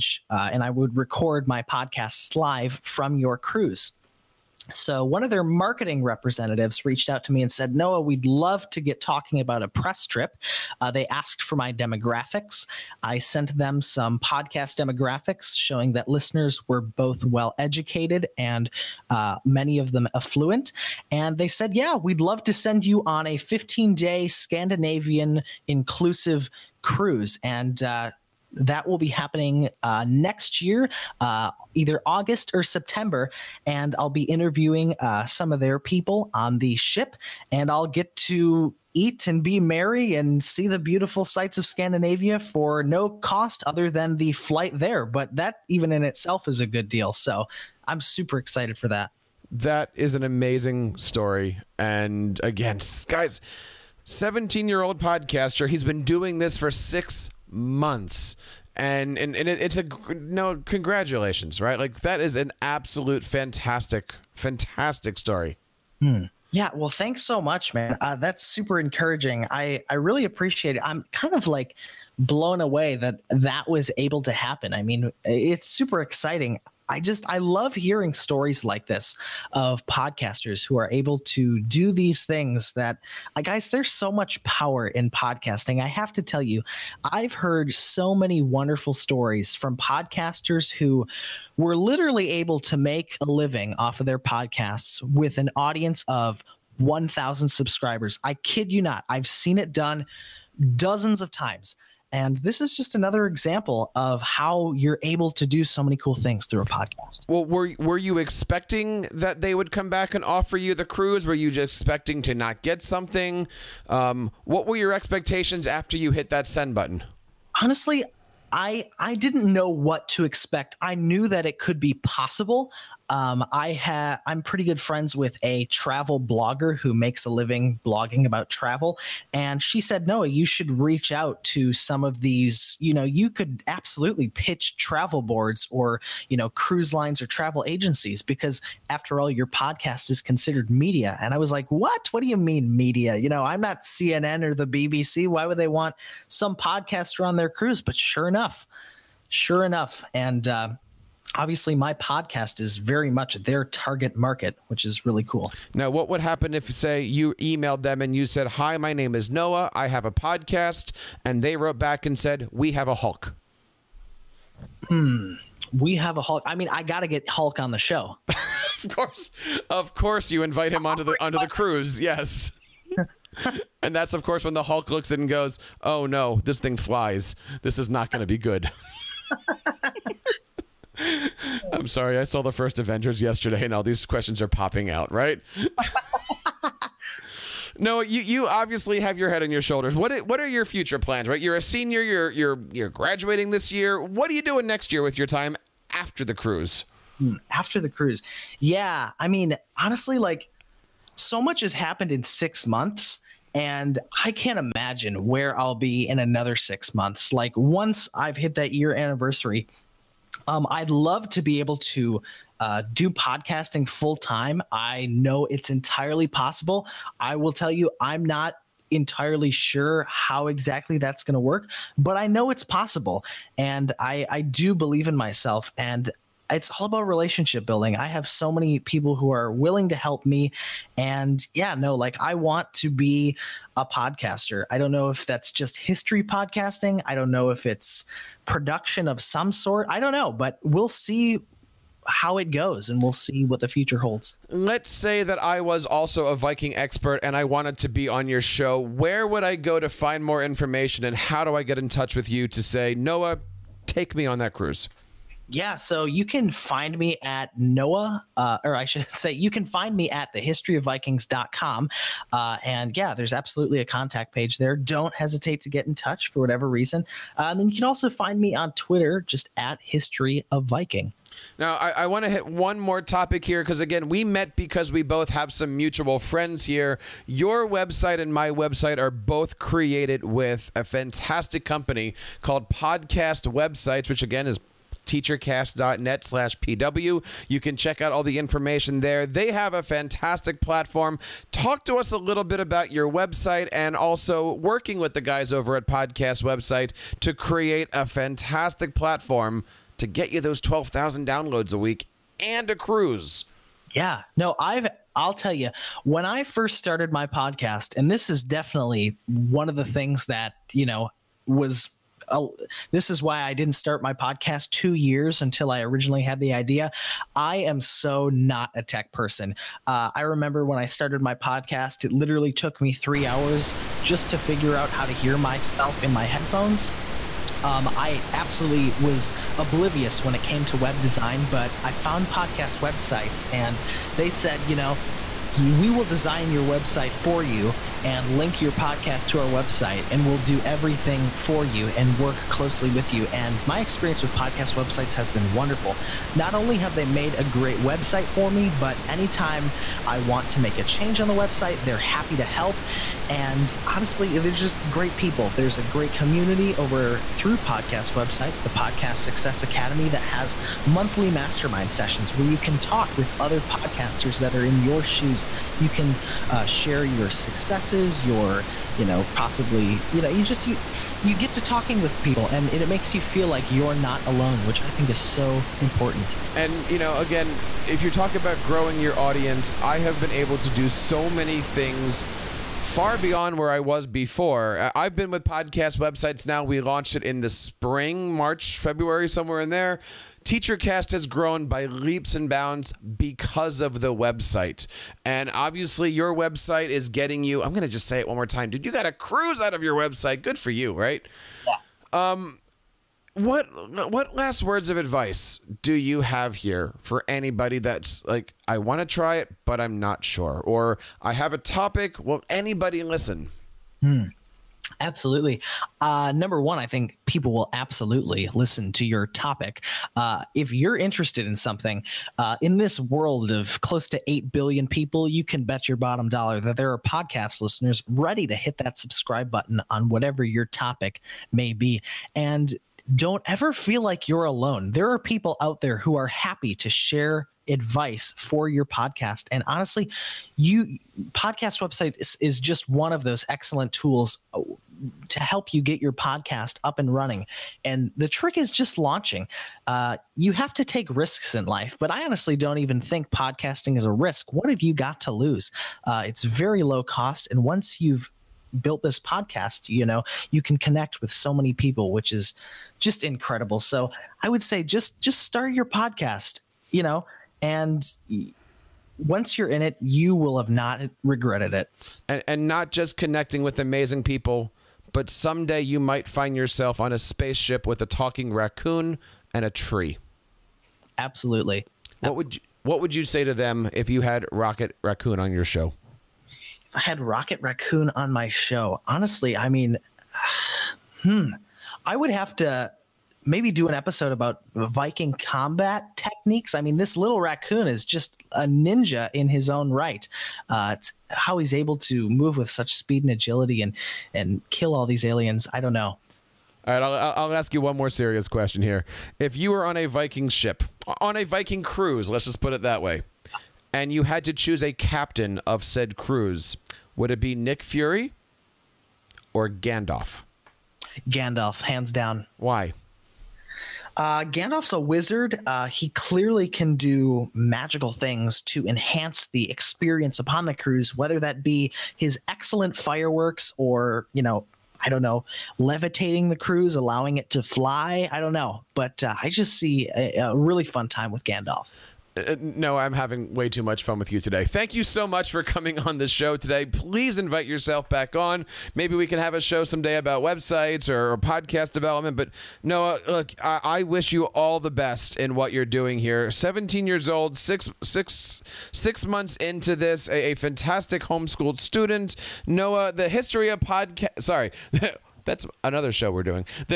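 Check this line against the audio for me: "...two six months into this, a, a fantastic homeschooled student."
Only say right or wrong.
wrong.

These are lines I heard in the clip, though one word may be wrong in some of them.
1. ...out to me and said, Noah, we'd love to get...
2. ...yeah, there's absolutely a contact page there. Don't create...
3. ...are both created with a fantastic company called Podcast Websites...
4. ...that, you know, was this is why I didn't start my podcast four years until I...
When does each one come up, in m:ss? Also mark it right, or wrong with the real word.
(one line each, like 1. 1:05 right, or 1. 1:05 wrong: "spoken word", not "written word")
1. 0:07 right
2. 4:22 wrong: "hesitate", not "create"
3. 4:38 right
4. 5:10 wrong: "two", not "four".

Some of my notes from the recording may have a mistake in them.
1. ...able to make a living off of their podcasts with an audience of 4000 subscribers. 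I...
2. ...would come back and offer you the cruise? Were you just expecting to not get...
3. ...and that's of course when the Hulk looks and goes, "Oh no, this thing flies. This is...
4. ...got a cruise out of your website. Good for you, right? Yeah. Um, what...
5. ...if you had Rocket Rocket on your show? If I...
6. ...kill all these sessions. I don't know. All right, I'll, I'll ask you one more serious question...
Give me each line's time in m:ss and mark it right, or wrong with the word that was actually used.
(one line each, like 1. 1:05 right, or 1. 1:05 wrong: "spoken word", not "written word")
1. 1:32 wrong: "1000", not "4000"
2. 1:49 right
3. 2:53 right
4. 6:38 right
5. 8:03 wrong: "Raccoon", not "Rocket"
6. 8:24 wrong: "aliens", not "sessions".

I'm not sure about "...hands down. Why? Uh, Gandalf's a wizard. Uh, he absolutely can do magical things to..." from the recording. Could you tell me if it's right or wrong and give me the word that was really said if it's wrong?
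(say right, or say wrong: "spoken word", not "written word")
wrong: "clearly", not "absolutely".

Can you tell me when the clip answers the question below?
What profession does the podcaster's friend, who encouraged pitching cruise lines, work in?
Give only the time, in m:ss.
2:05.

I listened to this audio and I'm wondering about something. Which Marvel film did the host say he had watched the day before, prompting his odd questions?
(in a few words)
The first Avengers.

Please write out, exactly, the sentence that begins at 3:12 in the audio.
You're you're you're graduating this year.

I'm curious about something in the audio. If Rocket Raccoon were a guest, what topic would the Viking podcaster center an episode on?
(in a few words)
Viking combat techniques.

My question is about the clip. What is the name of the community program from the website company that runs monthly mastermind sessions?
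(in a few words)
Podcast Success Academy.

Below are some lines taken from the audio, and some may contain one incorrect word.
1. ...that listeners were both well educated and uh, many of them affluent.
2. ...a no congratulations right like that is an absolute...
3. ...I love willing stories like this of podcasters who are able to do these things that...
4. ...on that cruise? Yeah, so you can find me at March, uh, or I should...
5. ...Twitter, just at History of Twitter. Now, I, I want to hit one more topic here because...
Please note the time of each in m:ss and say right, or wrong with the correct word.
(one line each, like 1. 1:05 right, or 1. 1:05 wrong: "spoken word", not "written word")
1. 0:15 right
2. 0:59 right
3. 1:17 wrong: "hearing", not "willing"
4. 4:14 wrong: "Noah", not "March"
5. 4:28 wrong: "Viking", not "Twitter".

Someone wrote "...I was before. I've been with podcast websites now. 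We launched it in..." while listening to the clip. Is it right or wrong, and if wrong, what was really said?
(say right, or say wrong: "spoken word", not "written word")
right.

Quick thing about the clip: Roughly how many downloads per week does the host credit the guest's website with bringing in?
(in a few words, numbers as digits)
12,000.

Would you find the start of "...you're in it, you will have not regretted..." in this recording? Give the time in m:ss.
7:49.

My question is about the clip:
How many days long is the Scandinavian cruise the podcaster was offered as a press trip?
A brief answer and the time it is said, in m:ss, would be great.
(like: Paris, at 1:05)
15, at 0:23.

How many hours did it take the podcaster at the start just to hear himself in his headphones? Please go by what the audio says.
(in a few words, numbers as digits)
3.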